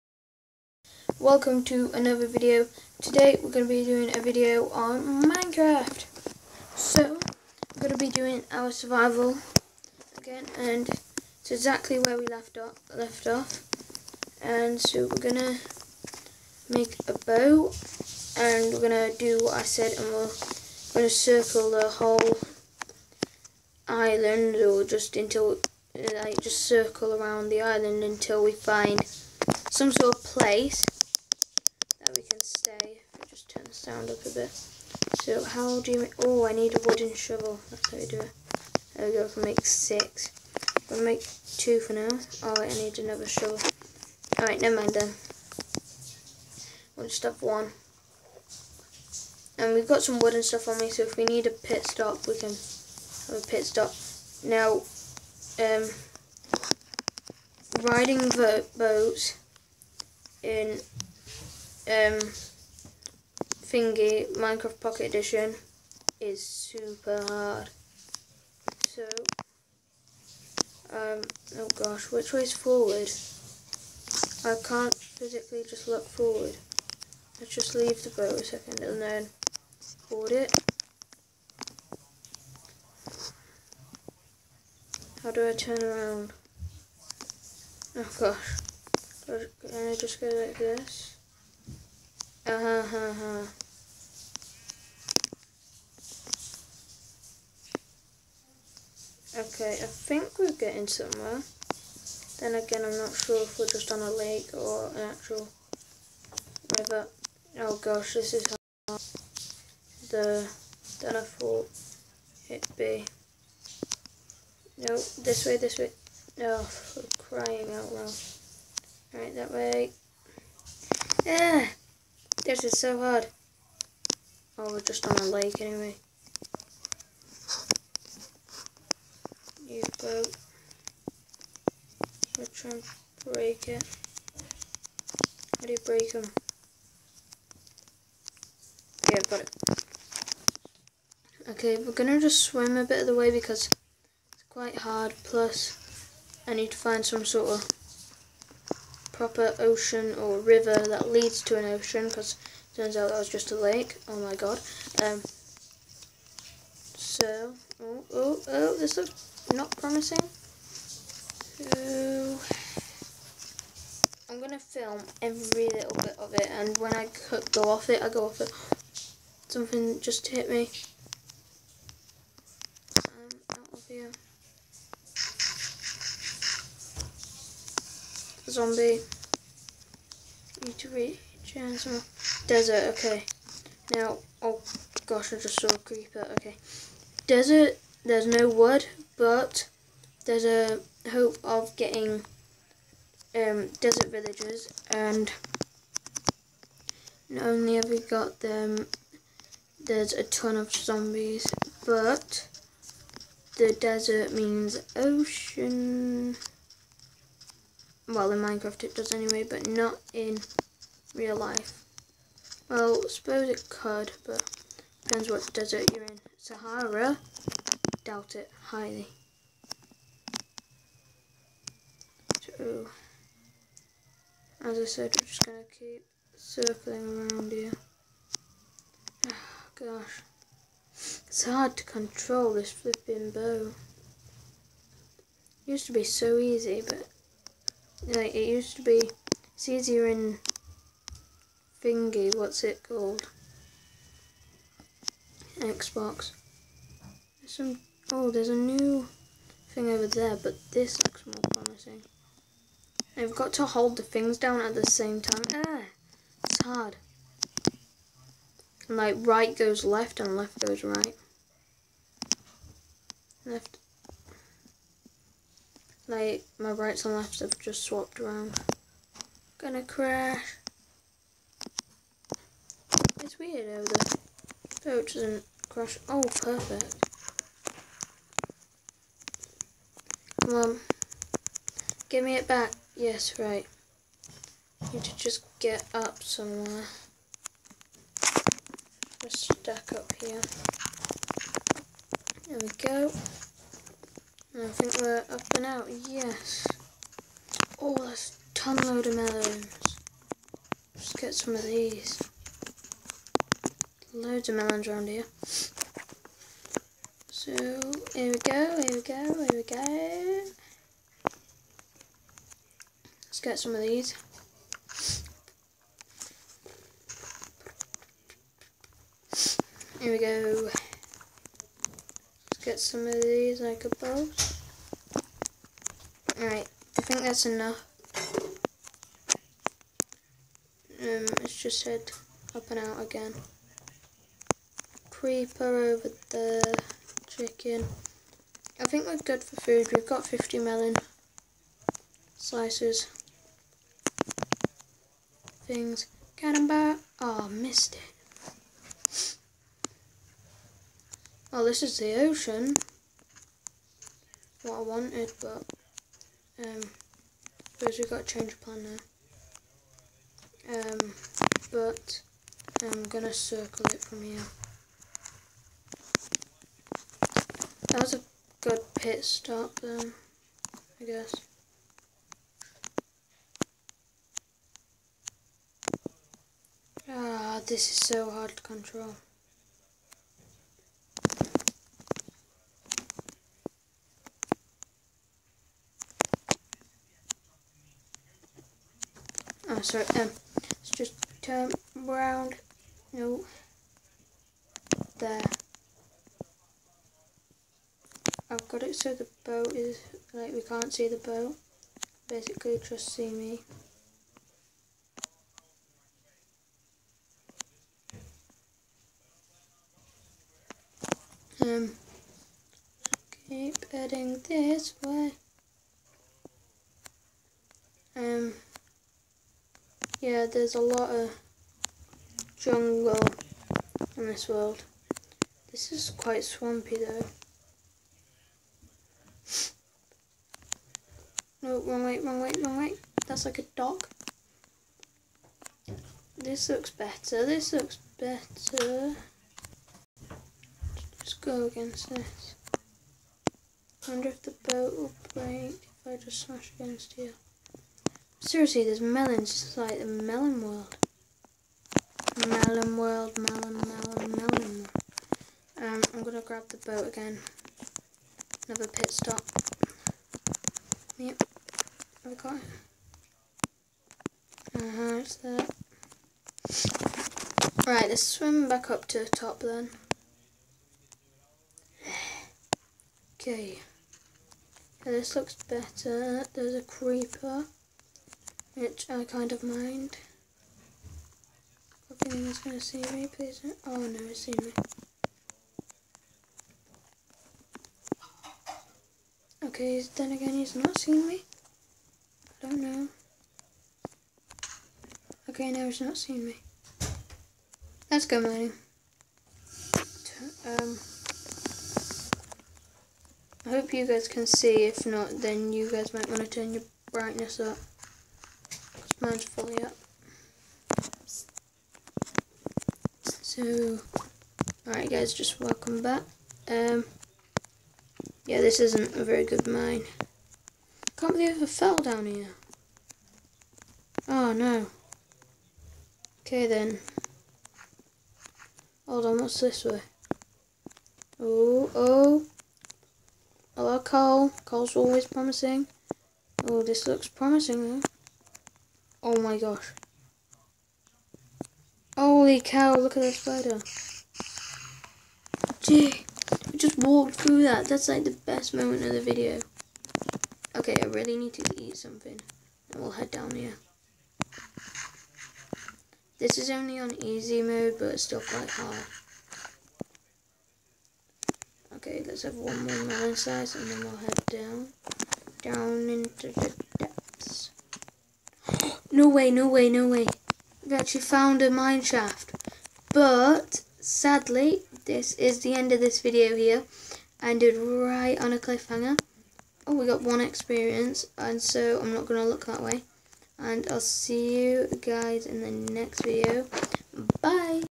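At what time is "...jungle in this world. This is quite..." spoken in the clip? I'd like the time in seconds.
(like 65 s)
422 s.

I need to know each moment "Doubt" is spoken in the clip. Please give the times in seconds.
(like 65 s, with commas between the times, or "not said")
218 s.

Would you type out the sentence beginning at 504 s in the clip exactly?
If not, then you guys might want to turn your brightness up mine's fully up.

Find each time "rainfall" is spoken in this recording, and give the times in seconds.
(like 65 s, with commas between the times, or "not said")
not said.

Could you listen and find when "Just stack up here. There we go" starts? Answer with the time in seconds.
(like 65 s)
289 s.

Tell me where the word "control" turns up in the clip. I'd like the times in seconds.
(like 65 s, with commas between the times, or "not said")
231 s, 378 s.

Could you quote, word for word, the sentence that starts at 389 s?
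Oh, sorry, um, let's just turn around.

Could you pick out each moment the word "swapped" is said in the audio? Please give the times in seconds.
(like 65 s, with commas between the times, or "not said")
267 s.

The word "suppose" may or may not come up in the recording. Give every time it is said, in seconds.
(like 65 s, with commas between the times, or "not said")
213 s, 357 s.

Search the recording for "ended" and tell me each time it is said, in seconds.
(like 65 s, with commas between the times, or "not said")
577 s.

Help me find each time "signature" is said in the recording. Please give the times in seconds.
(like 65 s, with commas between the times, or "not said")
not said.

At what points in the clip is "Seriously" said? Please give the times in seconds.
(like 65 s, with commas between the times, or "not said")
448 s.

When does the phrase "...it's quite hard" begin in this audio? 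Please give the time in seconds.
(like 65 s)
144 s.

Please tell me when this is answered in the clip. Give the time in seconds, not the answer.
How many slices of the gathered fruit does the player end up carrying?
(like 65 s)
340 s.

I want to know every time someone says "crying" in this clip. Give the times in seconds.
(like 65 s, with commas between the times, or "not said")
117 s.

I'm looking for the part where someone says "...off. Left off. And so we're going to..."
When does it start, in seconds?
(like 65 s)
12 s.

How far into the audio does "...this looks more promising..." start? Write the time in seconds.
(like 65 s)
250 s.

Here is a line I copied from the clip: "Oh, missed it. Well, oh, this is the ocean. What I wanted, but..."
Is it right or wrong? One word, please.
right.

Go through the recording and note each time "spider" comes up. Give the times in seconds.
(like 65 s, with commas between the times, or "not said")
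543 s.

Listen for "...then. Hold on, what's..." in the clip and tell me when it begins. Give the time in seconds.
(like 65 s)
526 s.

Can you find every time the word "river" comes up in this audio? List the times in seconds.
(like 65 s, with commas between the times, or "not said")
106 s, 150 s.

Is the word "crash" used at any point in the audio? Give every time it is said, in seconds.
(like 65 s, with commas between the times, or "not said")
269 s, 275 s.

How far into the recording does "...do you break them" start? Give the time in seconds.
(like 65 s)
135 s.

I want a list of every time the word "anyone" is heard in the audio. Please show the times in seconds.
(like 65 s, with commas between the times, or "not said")
482 s.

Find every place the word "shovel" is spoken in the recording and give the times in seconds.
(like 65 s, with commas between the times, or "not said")
37 s, 43 s.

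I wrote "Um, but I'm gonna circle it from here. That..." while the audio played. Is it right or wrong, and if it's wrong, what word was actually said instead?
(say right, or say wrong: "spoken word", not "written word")
right.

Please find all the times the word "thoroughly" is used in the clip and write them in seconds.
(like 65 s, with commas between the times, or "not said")
not said.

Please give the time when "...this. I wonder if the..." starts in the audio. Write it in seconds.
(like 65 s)
442 s.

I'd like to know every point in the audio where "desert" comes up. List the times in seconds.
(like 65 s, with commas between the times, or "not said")
182 s, 187 s, 193 s, 203 s, 215 s.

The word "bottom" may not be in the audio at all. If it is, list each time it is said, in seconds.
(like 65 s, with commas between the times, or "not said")
not said.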